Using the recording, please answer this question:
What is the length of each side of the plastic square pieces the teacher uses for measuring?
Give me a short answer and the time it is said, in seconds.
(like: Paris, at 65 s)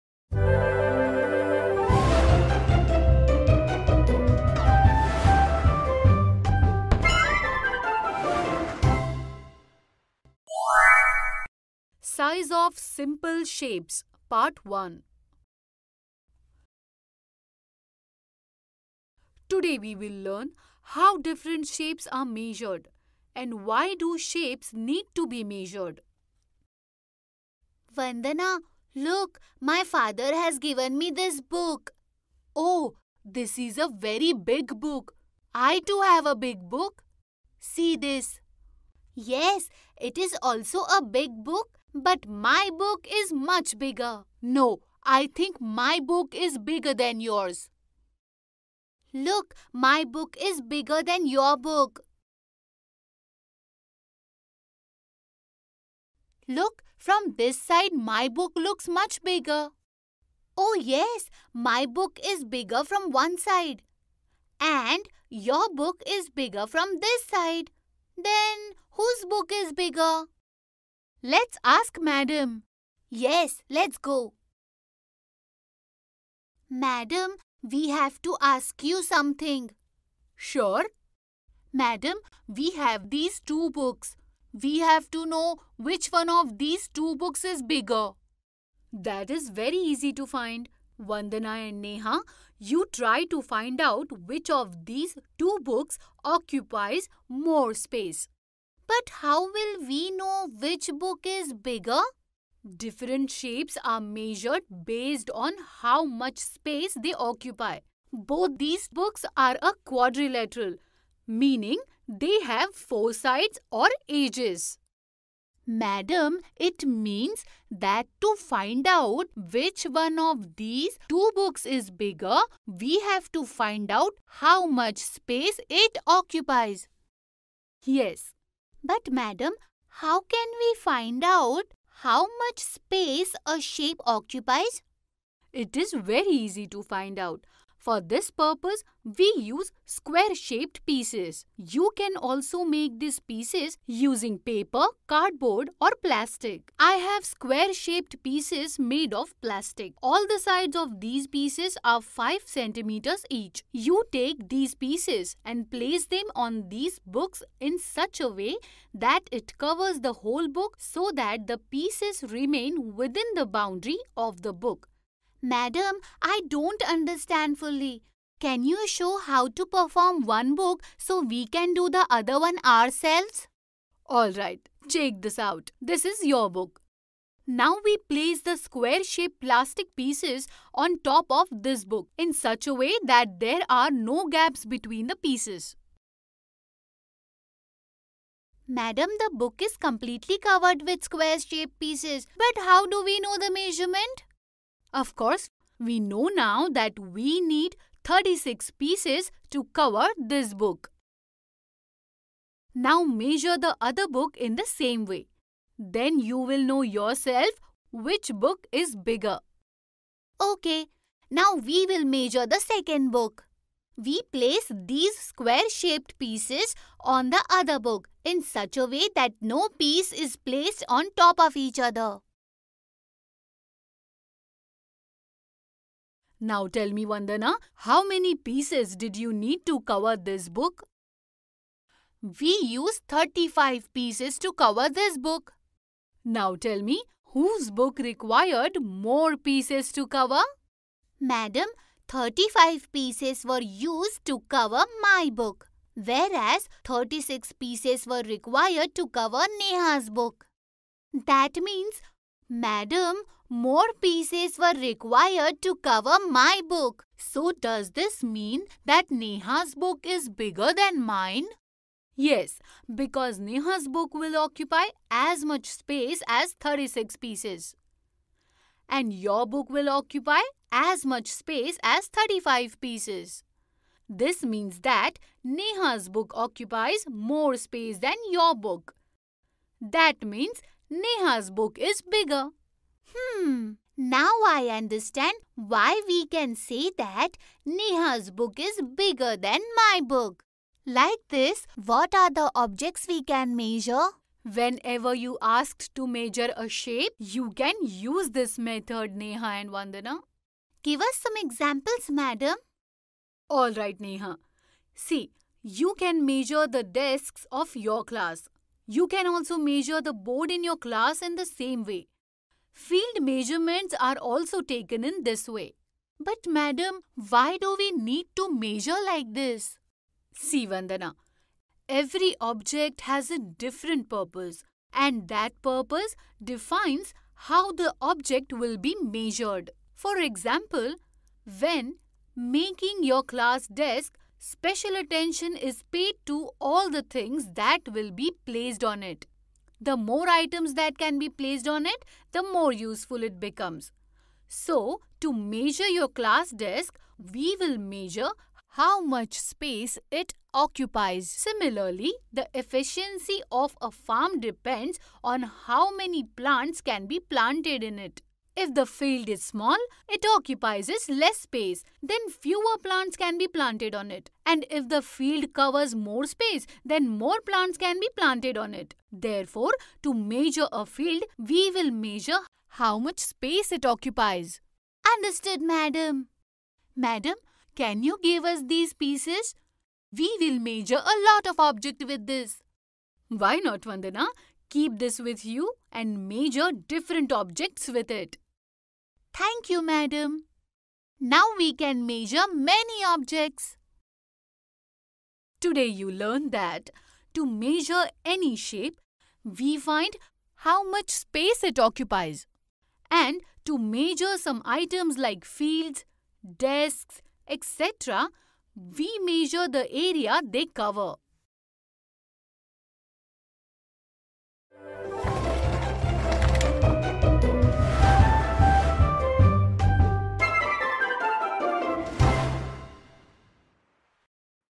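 5 centimeters, at 152 s.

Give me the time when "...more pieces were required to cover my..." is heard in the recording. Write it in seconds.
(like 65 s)
253 s.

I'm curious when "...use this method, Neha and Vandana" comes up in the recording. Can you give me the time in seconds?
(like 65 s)
297 s.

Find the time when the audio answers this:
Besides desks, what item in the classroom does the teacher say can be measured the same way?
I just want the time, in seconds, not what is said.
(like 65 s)
310 s.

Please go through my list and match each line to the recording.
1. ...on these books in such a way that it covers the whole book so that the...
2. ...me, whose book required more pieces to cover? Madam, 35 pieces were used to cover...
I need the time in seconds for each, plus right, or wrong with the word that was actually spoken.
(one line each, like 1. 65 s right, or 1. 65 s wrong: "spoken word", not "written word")
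1. 156 s right
2. 236 s right.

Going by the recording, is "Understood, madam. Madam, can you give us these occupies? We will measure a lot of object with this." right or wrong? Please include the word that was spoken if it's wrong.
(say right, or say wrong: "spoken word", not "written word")
wrong: "pieces", not "occupies".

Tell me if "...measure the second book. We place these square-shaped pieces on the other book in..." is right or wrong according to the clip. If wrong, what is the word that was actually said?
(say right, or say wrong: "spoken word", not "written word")
right.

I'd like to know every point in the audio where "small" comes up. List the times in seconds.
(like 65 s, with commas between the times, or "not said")
359 s.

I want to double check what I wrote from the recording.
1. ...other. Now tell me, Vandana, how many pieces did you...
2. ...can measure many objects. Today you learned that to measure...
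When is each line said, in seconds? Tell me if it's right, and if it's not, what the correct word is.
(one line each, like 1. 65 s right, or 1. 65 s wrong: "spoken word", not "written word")
1. 221 s right
2. 391 s right.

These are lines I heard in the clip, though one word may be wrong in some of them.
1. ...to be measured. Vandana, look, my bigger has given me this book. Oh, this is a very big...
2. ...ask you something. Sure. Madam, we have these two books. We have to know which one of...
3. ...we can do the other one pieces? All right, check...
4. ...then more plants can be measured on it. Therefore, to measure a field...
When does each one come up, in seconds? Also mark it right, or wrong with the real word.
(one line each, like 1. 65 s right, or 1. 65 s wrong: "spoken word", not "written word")
1. 25 s wrong: "father", not "bigger"
2. 78 s right
3. 171 s wrong: "ourselves", not "pieces"
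4. 366 s wrong: "planted", not "measured".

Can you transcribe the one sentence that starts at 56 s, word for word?
Look, from this side my book looks much bigger.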